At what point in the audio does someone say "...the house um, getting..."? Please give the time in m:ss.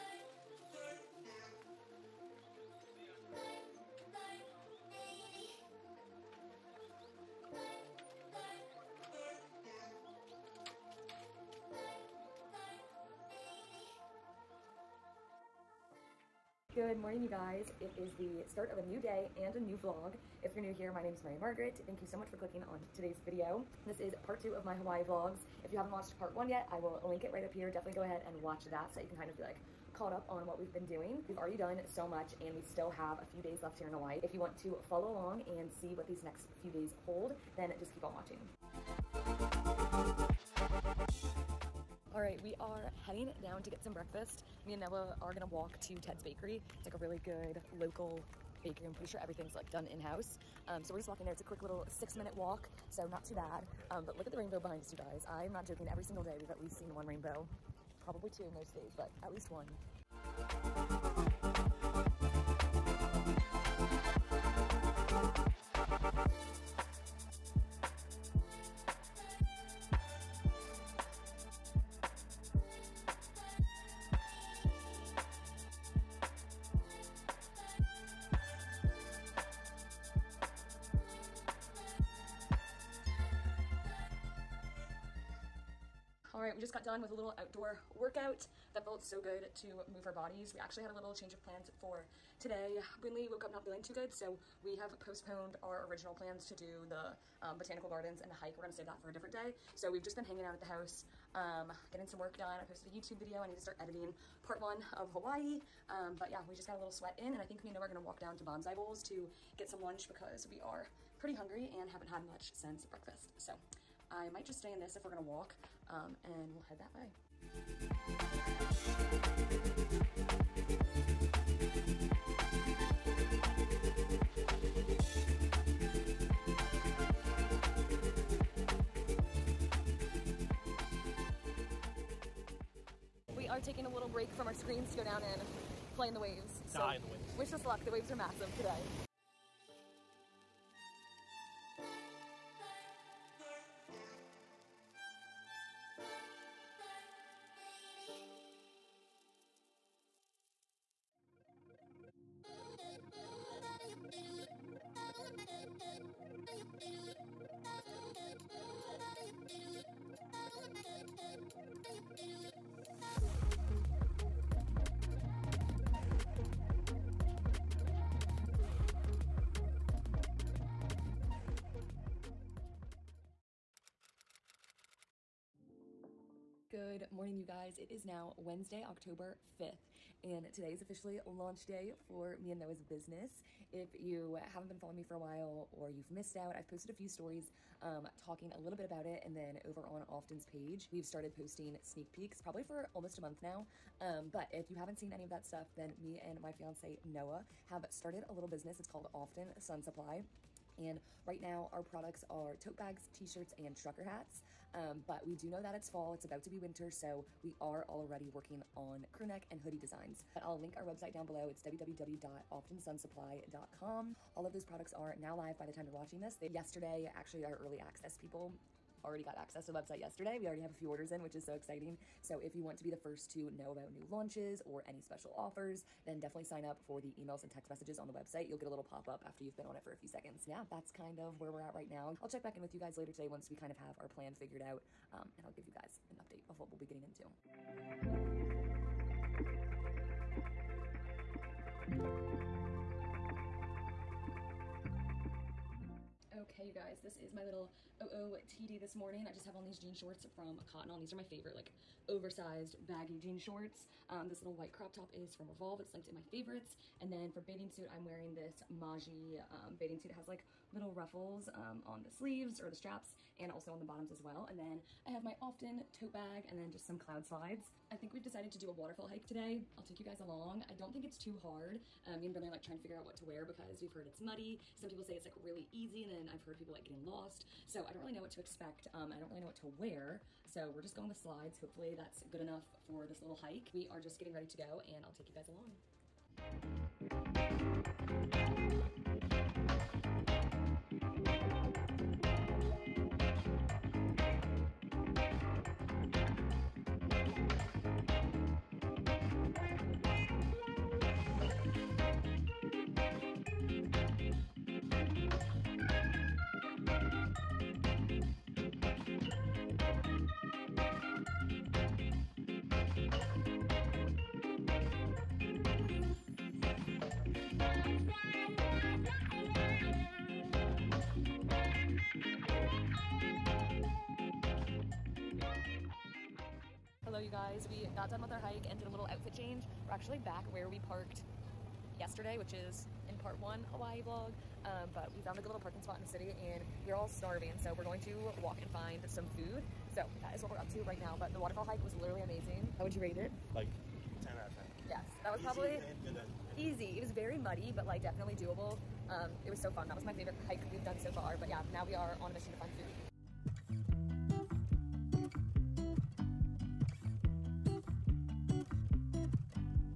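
1:40.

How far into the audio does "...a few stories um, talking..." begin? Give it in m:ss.
3:06.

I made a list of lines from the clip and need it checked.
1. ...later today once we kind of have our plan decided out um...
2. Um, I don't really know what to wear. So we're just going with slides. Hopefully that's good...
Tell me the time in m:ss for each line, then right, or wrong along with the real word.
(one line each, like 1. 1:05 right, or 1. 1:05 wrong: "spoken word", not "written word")
1. 3:52 wrong: "figured", not "decided"
2. 4:38 right.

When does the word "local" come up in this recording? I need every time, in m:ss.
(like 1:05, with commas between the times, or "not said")
0:47.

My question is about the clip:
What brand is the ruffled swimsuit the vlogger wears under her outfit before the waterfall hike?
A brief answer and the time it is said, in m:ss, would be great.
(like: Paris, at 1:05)
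Maaji, at 4:18.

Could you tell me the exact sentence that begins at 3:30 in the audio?
But I'll link our website down below.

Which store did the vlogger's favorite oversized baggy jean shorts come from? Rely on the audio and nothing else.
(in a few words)
Cotton On.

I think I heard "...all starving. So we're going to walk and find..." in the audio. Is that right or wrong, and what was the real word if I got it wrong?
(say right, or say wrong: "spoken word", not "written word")
right.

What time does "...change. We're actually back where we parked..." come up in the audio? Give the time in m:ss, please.
5:29.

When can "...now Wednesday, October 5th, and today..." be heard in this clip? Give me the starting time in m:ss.
2:58.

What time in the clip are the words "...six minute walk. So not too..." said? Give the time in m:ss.
0:51.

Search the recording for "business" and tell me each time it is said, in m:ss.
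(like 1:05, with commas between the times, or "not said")
3:02, 3:18.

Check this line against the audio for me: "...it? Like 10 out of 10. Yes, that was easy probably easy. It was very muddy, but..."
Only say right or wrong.
right.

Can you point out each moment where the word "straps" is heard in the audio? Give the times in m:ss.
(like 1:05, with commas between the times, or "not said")
4:22.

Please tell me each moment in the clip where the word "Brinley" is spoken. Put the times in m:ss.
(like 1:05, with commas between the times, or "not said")
1:33, 4:32.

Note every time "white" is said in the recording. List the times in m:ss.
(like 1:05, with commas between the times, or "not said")
4:14.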